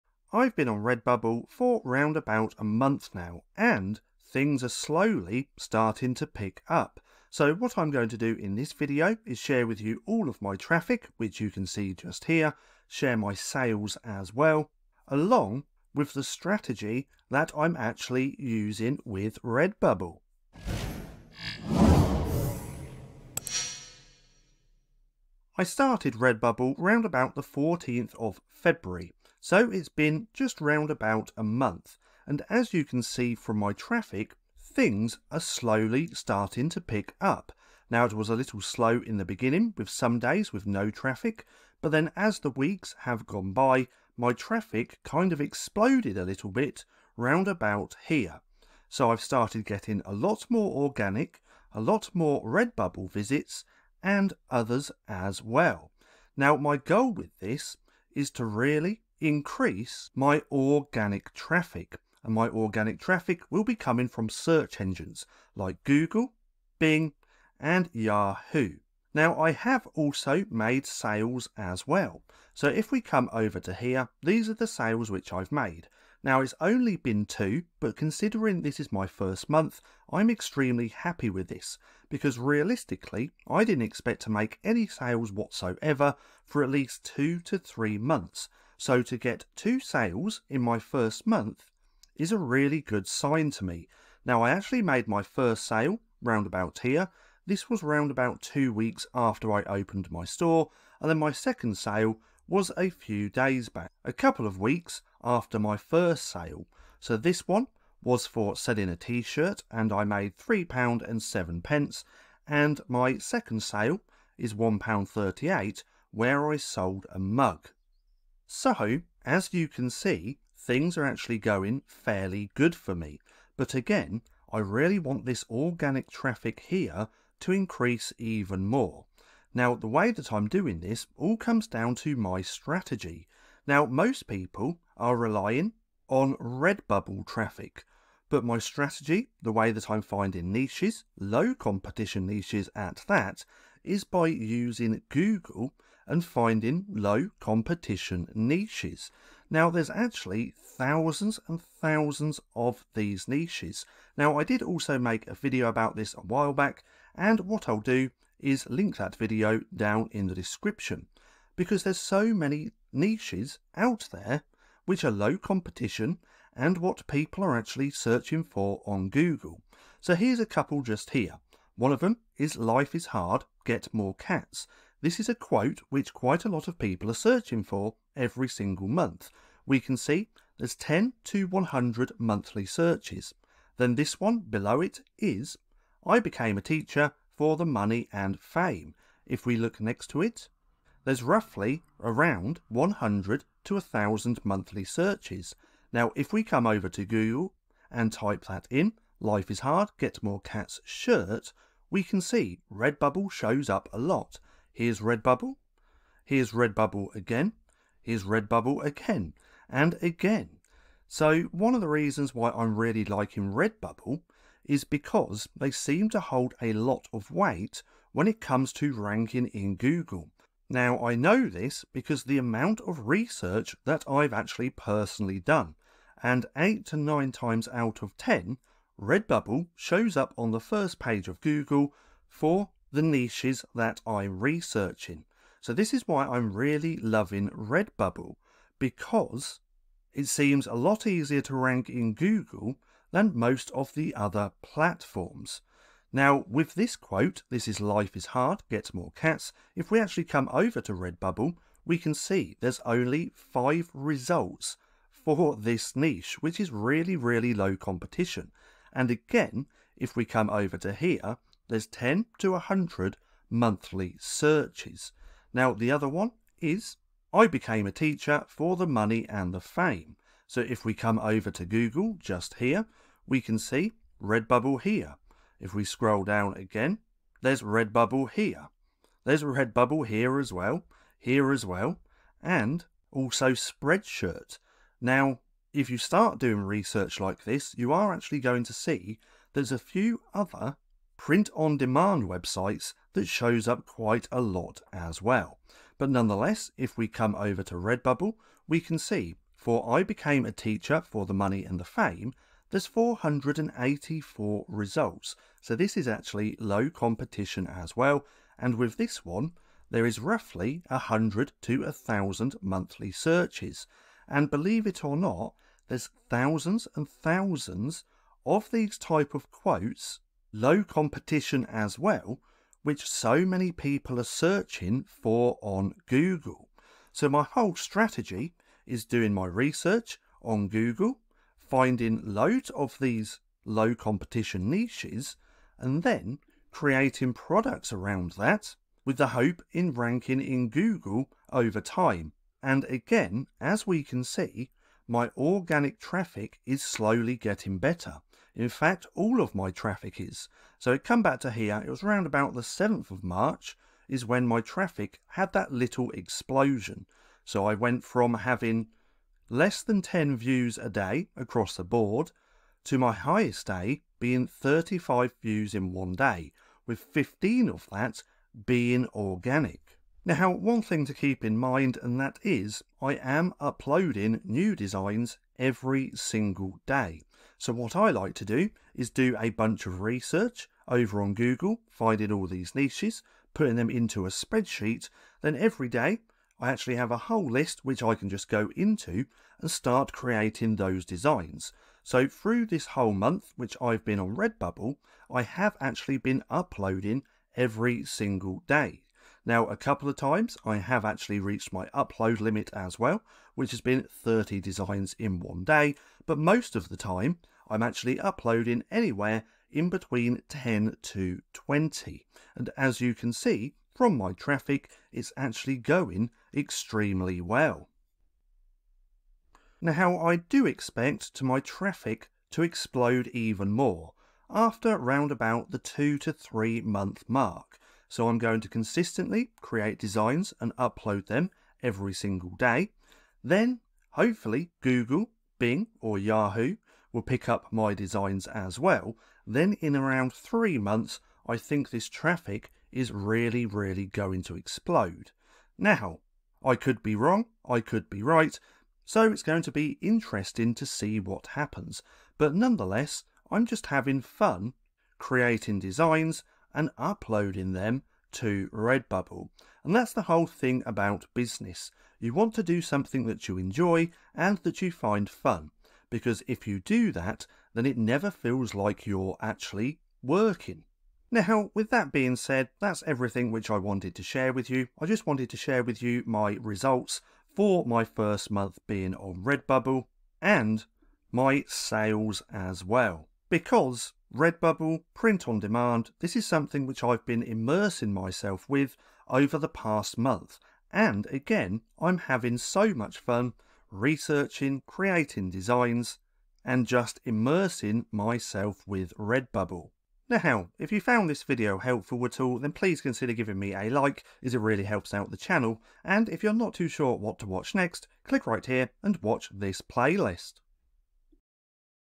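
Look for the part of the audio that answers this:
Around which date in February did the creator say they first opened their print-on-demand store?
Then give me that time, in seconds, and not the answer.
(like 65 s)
27 s.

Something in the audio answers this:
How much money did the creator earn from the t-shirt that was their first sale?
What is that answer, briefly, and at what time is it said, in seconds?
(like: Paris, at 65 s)
£3.07, at 110 s.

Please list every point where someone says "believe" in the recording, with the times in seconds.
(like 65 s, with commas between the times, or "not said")
314 s.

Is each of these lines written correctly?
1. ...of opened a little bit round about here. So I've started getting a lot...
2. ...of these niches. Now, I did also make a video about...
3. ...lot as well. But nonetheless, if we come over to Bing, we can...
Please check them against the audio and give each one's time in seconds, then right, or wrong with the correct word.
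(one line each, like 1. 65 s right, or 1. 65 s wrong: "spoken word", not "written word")
1. 45 s wrong: "exploded", not "opened"
2. 152 s right
3. 294 s wrong: "Redbubble", not "Bing".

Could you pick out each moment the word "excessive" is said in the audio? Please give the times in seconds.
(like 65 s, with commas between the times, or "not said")
not said.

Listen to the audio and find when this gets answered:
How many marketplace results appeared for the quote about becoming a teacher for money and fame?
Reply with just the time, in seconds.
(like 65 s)
302 s.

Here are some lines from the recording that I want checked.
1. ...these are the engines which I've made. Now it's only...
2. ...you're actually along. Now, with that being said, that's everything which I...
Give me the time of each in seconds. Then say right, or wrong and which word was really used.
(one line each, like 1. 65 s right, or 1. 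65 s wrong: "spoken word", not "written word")
1. 74 s wrong: "sales", not "engines"
2. 469 s wrong: "working", not "along".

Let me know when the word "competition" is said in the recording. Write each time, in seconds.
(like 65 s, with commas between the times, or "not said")
141 s, 147 s, 165 s, 257 s, 306 s, 320 s, 333 s.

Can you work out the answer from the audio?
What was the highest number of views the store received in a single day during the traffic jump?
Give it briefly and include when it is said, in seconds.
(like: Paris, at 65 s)
35, at 364 s.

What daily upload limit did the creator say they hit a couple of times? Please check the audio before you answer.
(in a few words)
30 designs.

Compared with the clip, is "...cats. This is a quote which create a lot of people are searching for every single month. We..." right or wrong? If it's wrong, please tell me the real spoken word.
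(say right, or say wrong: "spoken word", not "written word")
wrong: "quite", not "create".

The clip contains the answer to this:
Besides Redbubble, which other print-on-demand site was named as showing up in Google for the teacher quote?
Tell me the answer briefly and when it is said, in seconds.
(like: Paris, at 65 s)
Spreadshirt, at 283 s.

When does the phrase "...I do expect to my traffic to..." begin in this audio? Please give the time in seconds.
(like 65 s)
420 s.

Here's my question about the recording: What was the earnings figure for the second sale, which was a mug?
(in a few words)
£1.38.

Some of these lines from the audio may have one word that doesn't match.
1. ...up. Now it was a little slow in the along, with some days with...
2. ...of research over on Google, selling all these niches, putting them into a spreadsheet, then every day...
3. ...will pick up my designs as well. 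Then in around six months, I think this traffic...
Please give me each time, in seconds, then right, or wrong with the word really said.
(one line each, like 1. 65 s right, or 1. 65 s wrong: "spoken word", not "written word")
1. 37 s wrong: "beginning", not "along"
2. 379 s wrong: "finding", not "selling"
3. 437 s wrong: "three", not "six".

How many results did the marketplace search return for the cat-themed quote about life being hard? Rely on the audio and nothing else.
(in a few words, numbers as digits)
5.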